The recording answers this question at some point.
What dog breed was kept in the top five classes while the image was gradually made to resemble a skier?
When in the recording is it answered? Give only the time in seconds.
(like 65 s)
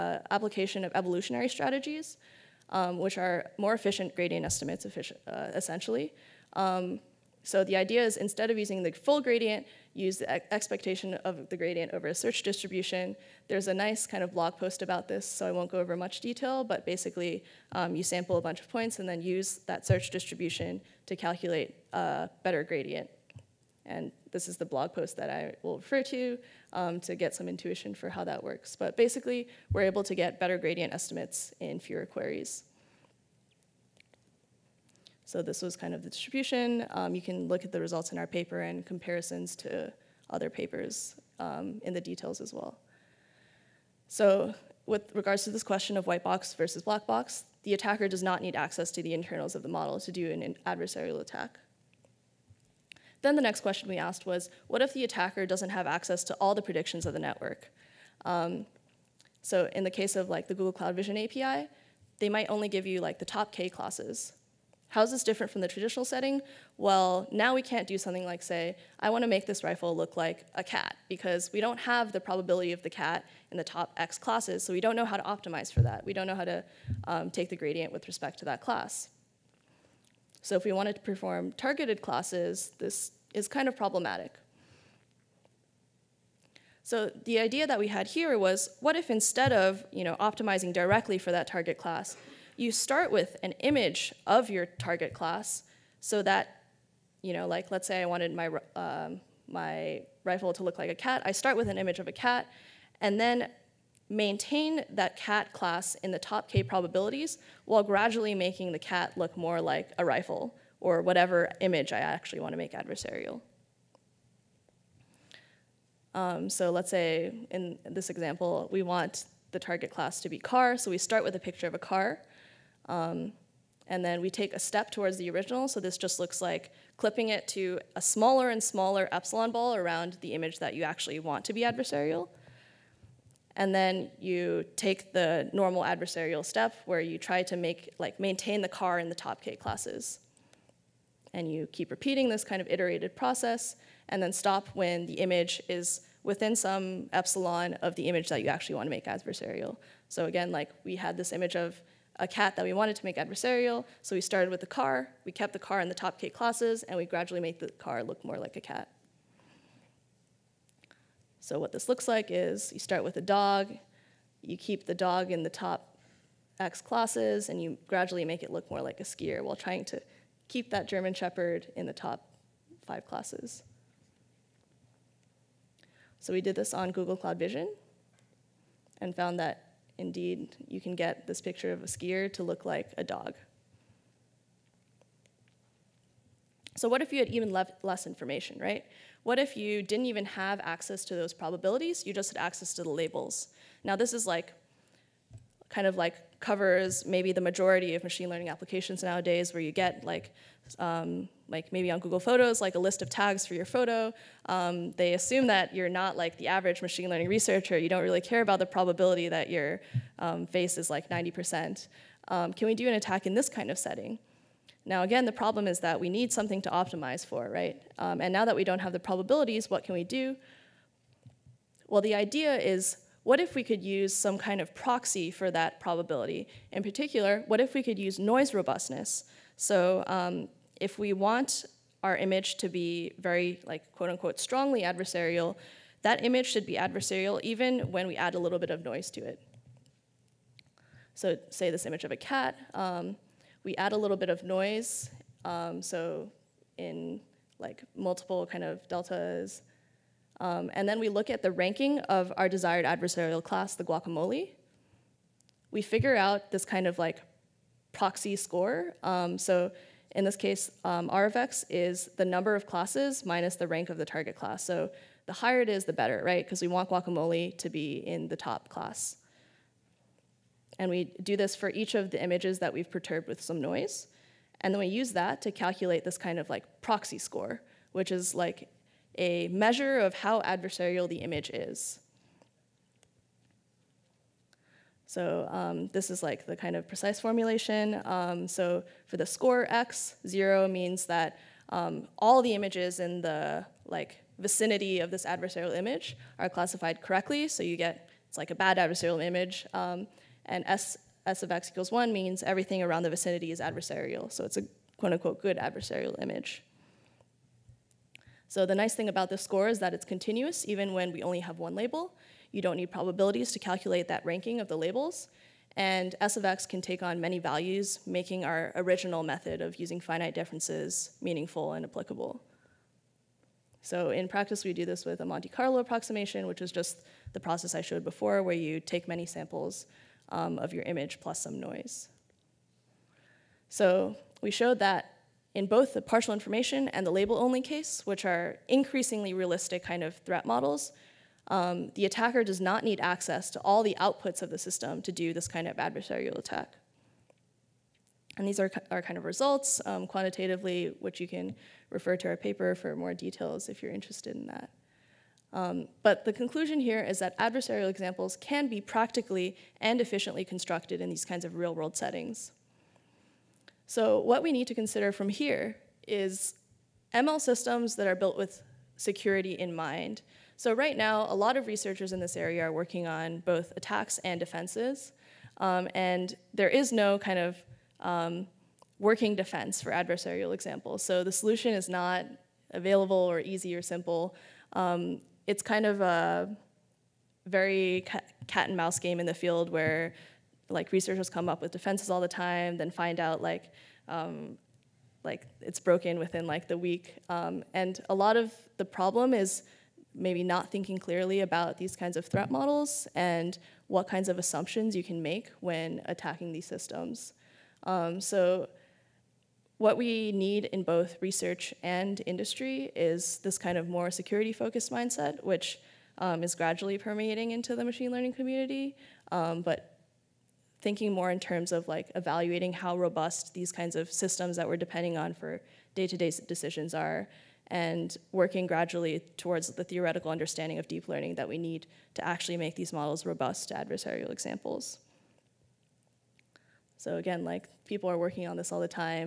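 170 s.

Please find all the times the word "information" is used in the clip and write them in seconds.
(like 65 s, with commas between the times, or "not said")
188 s, 336 s.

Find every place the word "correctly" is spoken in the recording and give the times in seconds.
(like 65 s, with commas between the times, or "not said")
297 s.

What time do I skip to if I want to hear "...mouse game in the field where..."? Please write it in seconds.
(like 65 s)
388 s.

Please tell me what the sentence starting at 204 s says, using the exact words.
Um, they assume that you're not like the average machine learning researcher.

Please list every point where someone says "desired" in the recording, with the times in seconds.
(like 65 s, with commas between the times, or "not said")
252 s.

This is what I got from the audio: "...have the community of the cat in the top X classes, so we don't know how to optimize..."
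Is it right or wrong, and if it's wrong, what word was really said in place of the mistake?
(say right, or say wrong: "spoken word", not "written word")
wrong: "probability", not "community".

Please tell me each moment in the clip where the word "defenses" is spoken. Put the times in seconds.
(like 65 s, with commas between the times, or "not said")
374 s, 379 s, 391 s.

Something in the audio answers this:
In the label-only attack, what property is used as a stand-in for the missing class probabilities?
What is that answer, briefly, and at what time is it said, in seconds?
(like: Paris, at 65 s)
noise robustness, at 228 s.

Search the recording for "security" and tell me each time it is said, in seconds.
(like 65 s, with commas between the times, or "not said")
368 s, 414 s.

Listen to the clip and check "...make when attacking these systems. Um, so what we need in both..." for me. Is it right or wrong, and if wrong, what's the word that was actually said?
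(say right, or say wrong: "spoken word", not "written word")
right.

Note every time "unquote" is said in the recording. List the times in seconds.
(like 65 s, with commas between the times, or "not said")
234 s, 305 s.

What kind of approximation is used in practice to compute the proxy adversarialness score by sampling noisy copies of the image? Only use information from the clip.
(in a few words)
Monte Carlo approximation.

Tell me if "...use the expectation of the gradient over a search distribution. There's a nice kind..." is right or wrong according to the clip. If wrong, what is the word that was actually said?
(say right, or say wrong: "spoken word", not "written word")
right.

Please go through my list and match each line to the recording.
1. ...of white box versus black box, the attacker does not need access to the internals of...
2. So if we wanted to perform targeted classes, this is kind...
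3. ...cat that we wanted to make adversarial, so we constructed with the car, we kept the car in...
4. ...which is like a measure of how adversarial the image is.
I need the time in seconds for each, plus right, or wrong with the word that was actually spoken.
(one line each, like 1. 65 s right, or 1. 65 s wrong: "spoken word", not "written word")
1. 45 s right
2. 80 s right
3. 152 s wrong: "started", not "constructed"
4. 277 s right.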